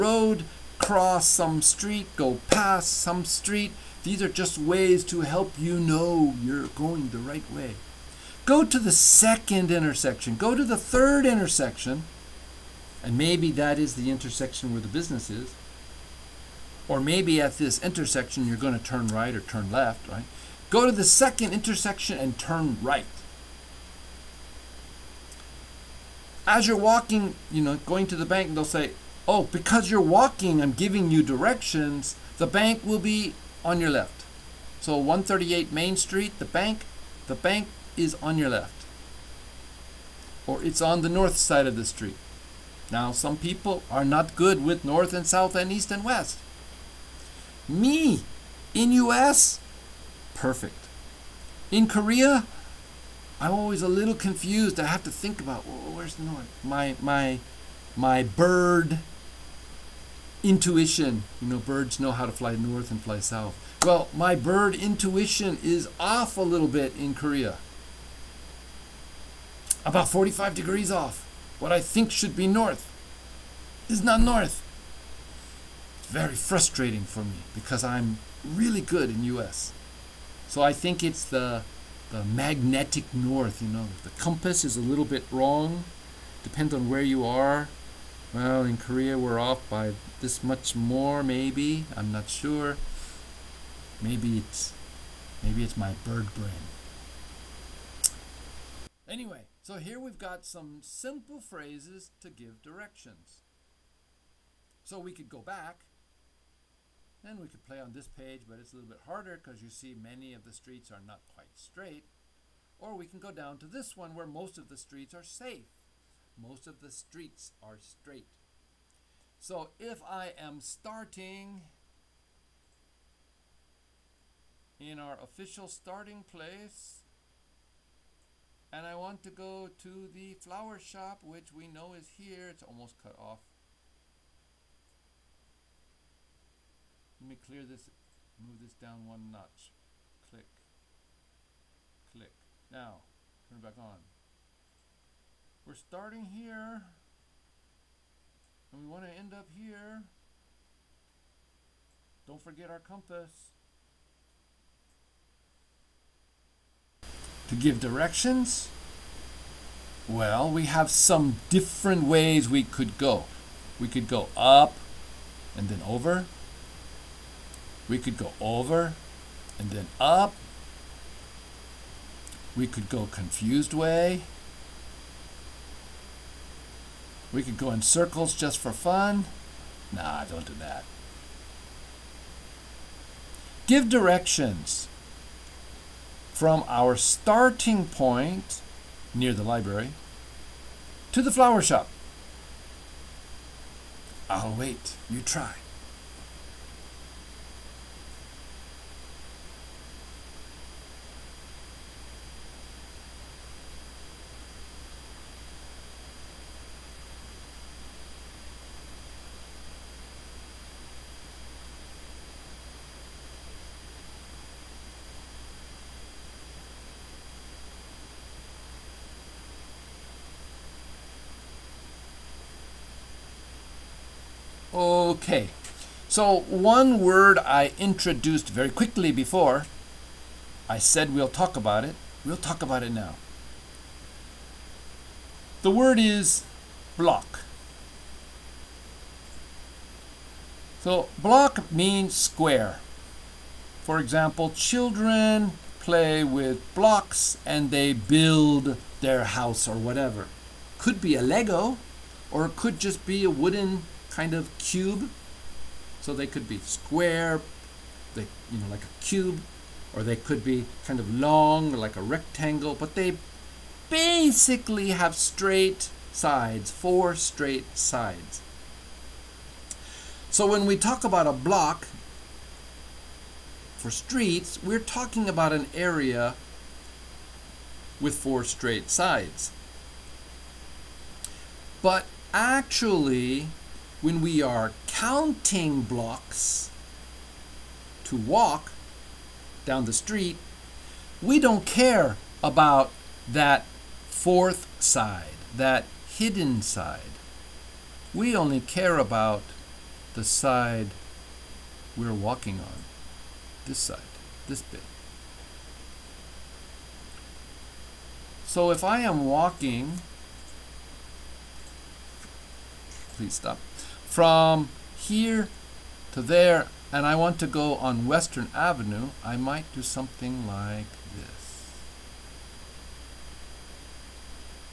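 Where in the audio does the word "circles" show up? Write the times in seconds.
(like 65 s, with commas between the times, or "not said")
177 s.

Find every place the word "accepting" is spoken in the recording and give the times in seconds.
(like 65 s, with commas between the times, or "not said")
not said.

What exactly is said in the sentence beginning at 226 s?
So one word I introduced very quickly before, I said we'll talk about it.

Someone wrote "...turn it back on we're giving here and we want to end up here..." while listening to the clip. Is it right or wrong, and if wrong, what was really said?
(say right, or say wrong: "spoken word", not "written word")
wrong: "starting", not "giving".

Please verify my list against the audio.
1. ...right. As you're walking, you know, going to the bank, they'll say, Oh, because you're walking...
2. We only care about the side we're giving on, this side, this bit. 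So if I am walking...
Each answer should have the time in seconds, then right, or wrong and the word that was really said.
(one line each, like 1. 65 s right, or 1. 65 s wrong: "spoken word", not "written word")
1. 22 s right
2. 298 s wrong: "walking", not "giving".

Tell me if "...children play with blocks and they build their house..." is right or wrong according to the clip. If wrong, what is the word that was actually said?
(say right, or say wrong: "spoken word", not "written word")
right.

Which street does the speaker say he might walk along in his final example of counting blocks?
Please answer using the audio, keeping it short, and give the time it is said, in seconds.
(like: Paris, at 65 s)
Western Avenue, at 318 s.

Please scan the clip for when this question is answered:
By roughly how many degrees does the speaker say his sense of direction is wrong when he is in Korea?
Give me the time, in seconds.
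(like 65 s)
69 s.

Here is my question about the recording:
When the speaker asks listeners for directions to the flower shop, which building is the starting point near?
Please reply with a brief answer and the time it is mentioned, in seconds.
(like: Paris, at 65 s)
The library, at 189 s.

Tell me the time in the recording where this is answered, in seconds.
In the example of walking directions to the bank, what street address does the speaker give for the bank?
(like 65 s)
34 s.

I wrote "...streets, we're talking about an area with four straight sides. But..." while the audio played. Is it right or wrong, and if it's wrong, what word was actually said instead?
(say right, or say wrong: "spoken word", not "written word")
right.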